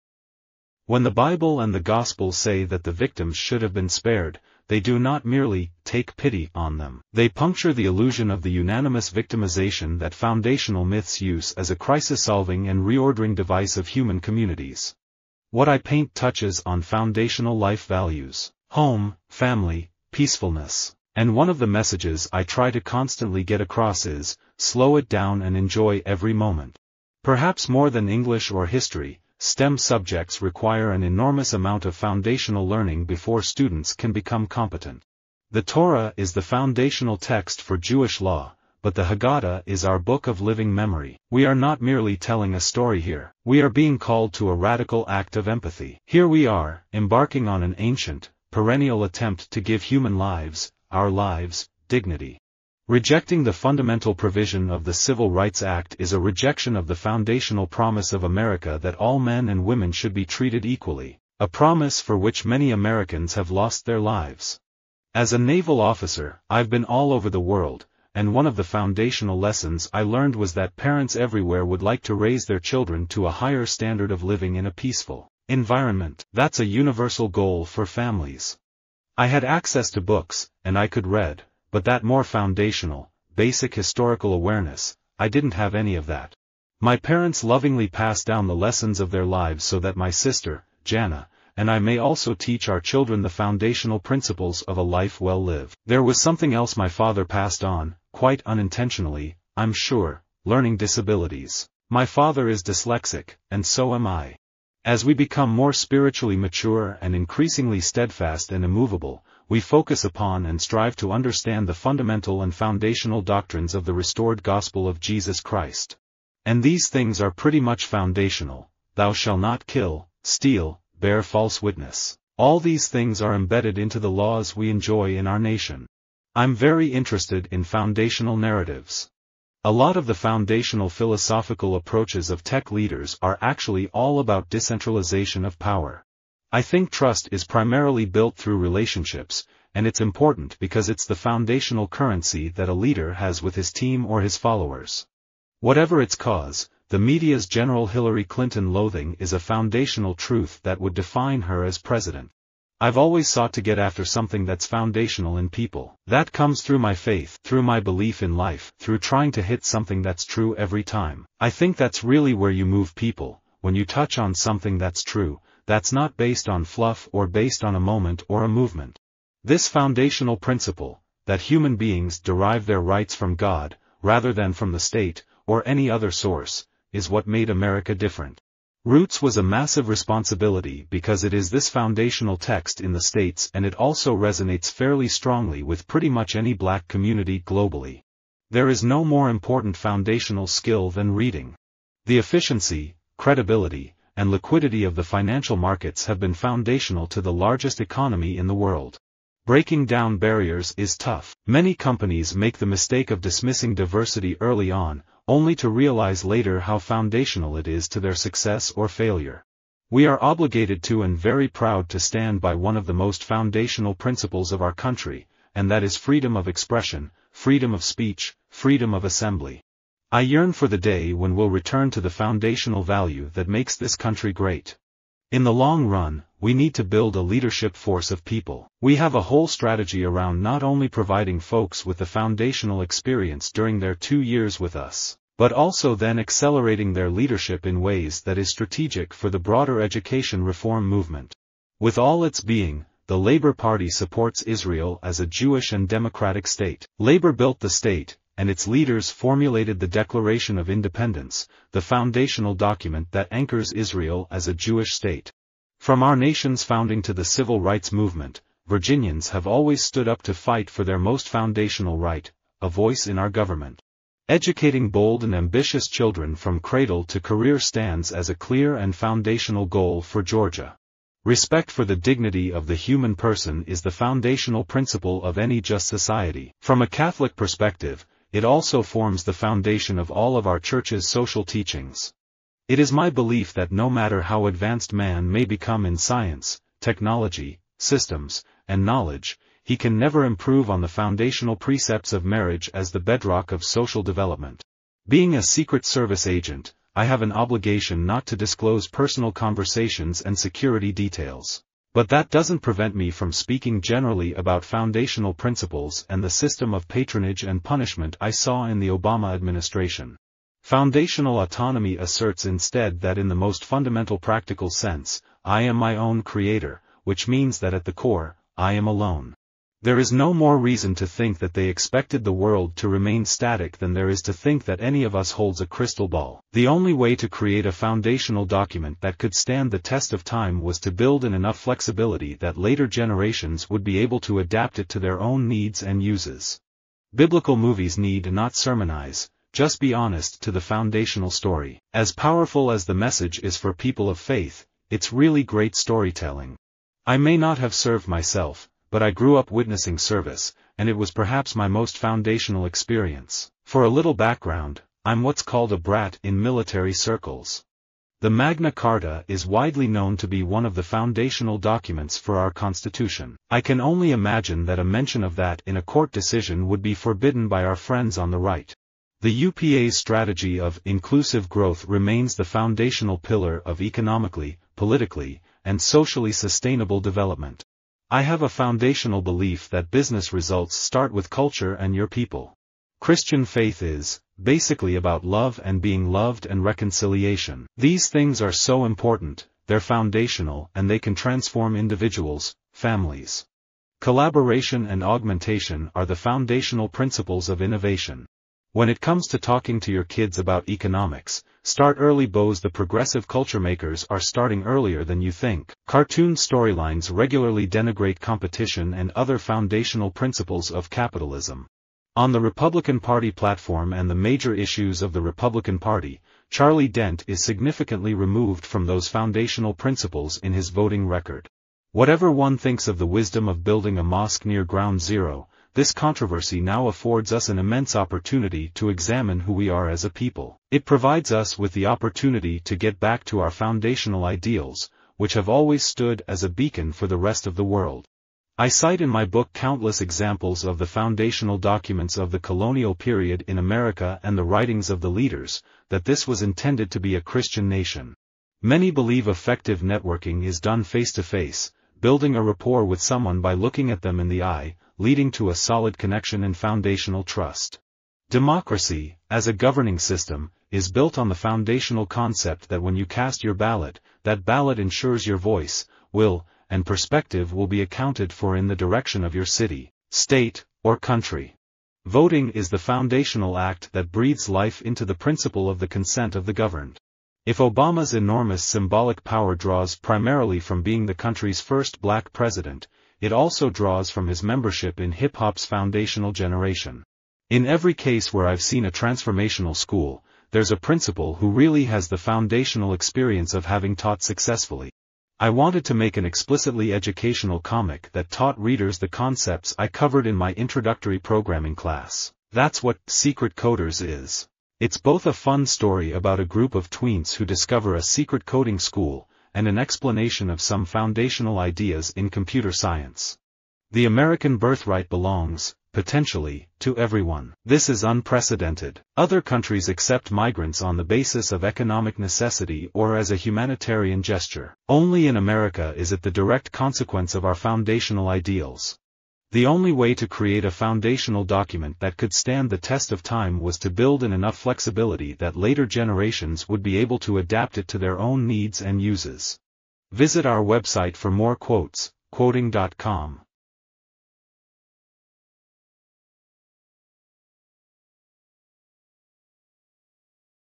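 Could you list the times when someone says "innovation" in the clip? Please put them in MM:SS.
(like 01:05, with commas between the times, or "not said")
06:37.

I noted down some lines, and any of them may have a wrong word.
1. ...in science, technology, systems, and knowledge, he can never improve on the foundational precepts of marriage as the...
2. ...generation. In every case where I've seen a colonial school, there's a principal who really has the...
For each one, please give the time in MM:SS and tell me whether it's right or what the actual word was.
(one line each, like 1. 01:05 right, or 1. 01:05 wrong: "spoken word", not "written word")
1. 04:45 right
2. 08:06 wrong: "transformational", not "colonial".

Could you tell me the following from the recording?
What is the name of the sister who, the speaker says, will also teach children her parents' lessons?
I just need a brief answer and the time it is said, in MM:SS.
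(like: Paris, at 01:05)
Jana, at 01:30.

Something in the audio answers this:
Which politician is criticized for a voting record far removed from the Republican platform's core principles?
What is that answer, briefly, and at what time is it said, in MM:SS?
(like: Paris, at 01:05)
Charlie Dent, at 06:56.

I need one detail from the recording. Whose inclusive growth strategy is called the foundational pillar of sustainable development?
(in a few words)
UPA.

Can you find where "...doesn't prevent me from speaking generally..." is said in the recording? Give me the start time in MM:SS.
05:02.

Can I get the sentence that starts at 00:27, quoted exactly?
Perhaps more than English or history, STEM subjects require an enormous amount of foundational learning before students can become competent.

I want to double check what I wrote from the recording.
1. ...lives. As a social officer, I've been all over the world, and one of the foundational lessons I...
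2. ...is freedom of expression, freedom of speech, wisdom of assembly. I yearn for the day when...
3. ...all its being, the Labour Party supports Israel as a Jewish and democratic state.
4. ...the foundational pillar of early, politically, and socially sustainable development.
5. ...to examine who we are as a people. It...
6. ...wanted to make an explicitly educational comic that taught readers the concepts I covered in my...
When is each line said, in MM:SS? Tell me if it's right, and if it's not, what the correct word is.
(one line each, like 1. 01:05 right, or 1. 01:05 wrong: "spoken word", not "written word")
1. 01:04 wrong: "naval", not "social"
2. 03:35 wrong: "freedom", not "wisdom"
3. 04:01 right
4. 06:12 wrong: "economically", not "early"
5. 07:08 right
6. 08:15 right.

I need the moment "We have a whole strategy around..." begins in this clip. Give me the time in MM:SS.
03:48.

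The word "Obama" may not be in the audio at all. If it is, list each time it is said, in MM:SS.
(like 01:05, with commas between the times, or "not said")
05:08, 07:57.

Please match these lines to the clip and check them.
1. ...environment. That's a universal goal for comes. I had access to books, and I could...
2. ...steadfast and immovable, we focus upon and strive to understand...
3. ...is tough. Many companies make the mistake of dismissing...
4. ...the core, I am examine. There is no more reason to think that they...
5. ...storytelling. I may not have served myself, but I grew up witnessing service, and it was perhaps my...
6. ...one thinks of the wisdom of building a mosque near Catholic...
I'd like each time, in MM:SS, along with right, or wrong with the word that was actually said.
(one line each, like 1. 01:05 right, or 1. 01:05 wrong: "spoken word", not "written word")
1. 01:15 wrong: "families", not "comes"
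2. 01:47 right
3. 03:20 right
4. 05:17 wrong: "alone", not "examine"
5. 05:45 right
6. 07:02 wrong: "Ground", not "Catholic".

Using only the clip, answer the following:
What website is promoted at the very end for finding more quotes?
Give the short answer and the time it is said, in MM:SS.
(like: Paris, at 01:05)
quoteing.com, at 09:02.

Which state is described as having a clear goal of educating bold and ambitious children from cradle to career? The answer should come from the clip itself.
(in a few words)
Georgia.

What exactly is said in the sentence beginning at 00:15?
What I paint touches on foundational life values, home, family, peacefulness.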